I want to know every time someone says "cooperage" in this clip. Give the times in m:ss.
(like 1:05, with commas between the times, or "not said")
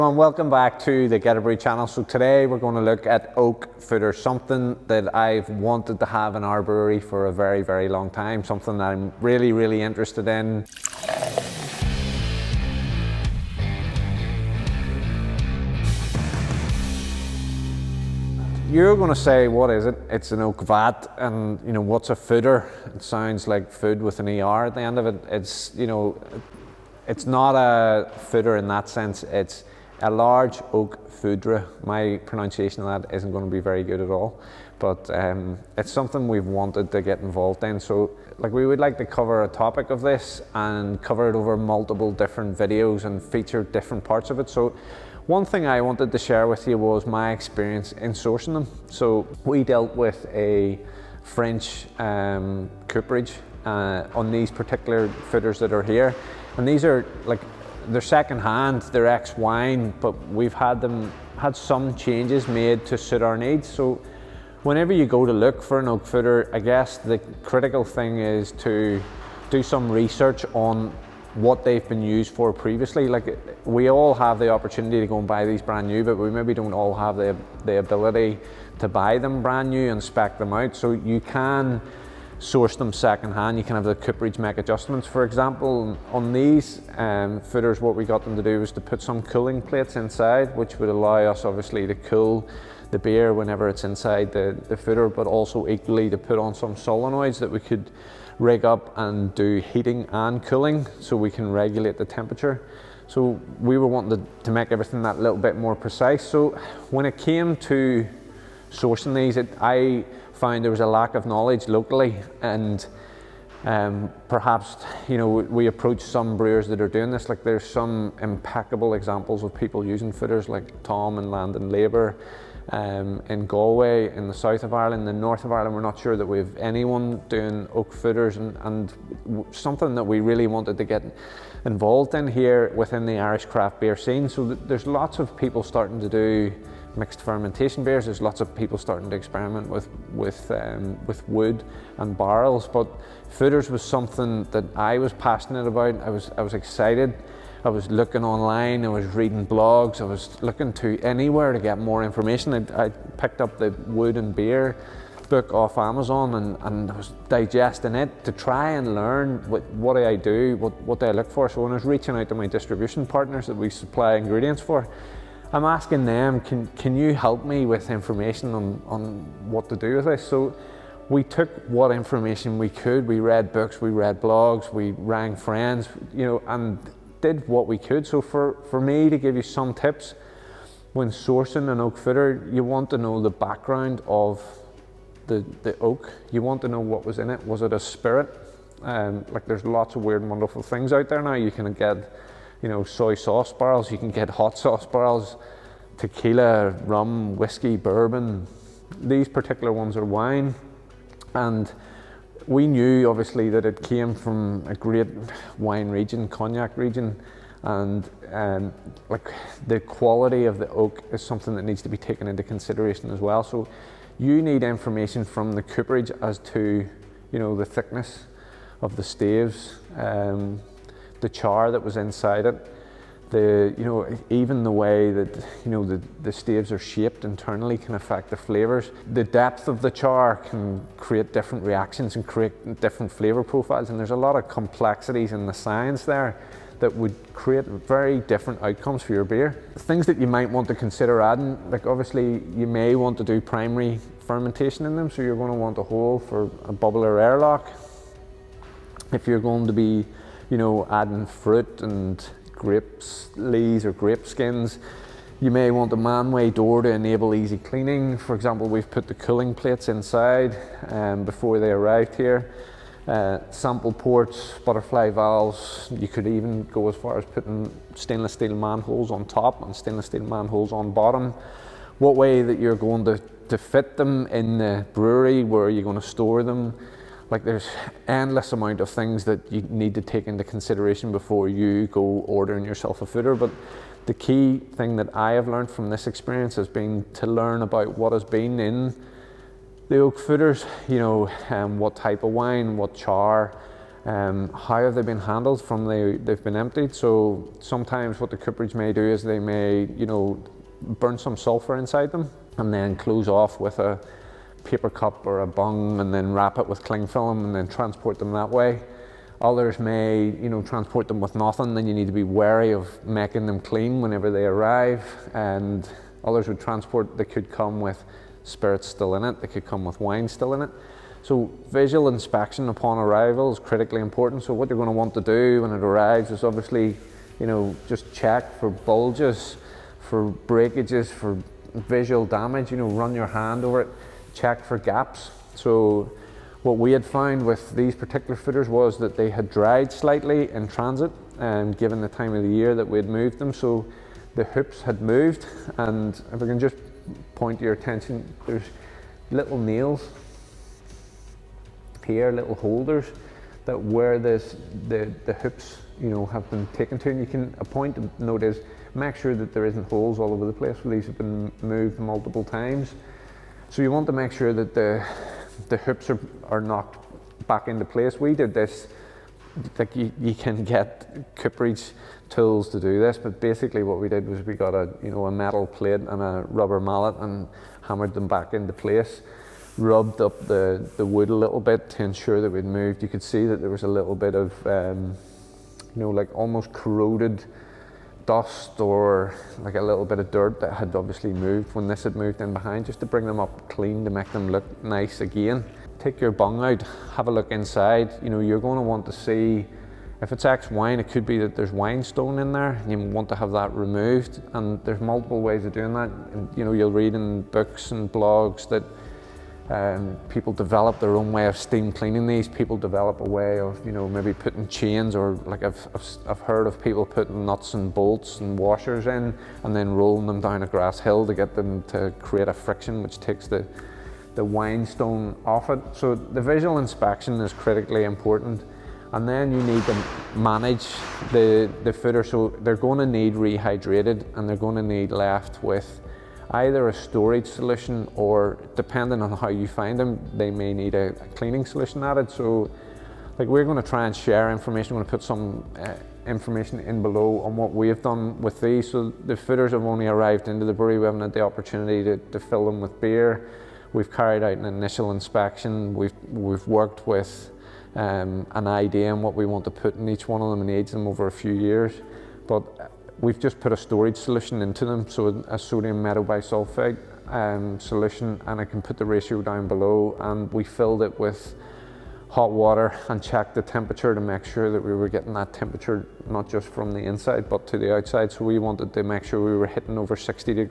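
0:52, 1:23, 3:35, 4:58, 6:11.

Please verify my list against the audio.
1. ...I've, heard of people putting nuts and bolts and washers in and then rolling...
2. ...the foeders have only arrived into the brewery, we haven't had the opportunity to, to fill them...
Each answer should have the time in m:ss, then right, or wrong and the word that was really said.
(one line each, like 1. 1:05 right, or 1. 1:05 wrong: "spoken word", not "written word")
1. 6:56 right
2. 7:29 right.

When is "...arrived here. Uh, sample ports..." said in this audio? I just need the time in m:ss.
4:21.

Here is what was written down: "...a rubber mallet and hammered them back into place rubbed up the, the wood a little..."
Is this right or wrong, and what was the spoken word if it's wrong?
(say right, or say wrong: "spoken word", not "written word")
right.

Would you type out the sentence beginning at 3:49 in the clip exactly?
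The depth of the char can create different reactions and create different flavor profiles.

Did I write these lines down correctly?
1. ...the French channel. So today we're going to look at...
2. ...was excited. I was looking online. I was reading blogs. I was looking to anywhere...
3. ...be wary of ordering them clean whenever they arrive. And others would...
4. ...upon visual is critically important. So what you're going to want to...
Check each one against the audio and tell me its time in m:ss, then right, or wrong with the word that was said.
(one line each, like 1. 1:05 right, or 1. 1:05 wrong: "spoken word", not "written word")
1. 0:01 wrong: "Geterbrewed", not "French"
2. 2:26 right
3. 5:12 wrong: "making", not "ordering"
4. 5:22 wrong: "arrival", not "visual".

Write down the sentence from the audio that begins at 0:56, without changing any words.
And these are like, they're second hand, they're ex-wine, but we've had them, had some changes made to suit our needs.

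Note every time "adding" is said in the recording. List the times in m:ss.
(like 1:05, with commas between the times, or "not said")
4:01, 4:10.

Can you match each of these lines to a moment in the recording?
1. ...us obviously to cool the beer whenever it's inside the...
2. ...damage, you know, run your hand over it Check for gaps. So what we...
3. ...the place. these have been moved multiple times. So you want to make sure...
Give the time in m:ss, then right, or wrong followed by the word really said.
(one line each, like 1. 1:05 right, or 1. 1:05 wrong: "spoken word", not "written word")
1. 1:31 right
2. 5:32 right
3. 6:00 right.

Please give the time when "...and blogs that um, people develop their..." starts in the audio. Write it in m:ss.
6:47.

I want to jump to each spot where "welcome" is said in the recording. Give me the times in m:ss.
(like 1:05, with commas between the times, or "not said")
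0:00.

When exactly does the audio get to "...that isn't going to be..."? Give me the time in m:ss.
0:33.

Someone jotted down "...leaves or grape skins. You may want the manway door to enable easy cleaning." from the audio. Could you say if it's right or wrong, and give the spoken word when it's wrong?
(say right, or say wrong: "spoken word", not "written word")
right.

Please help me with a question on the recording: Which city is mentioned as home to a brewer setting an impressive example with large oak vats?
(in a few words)
Galway.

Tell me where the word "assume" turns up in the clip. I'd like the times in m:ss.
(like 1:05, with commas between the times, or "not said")
not said.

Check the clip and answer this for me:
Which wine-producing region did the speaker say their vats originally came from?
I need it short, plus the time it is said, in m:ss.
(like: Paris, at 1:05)
Cognac, at 3:26.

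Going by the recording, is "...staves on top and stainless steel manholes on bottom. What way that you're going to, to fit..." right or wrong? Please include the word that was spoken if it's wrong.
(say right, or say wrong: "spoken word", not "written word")
wrong: "manholes", not "staves".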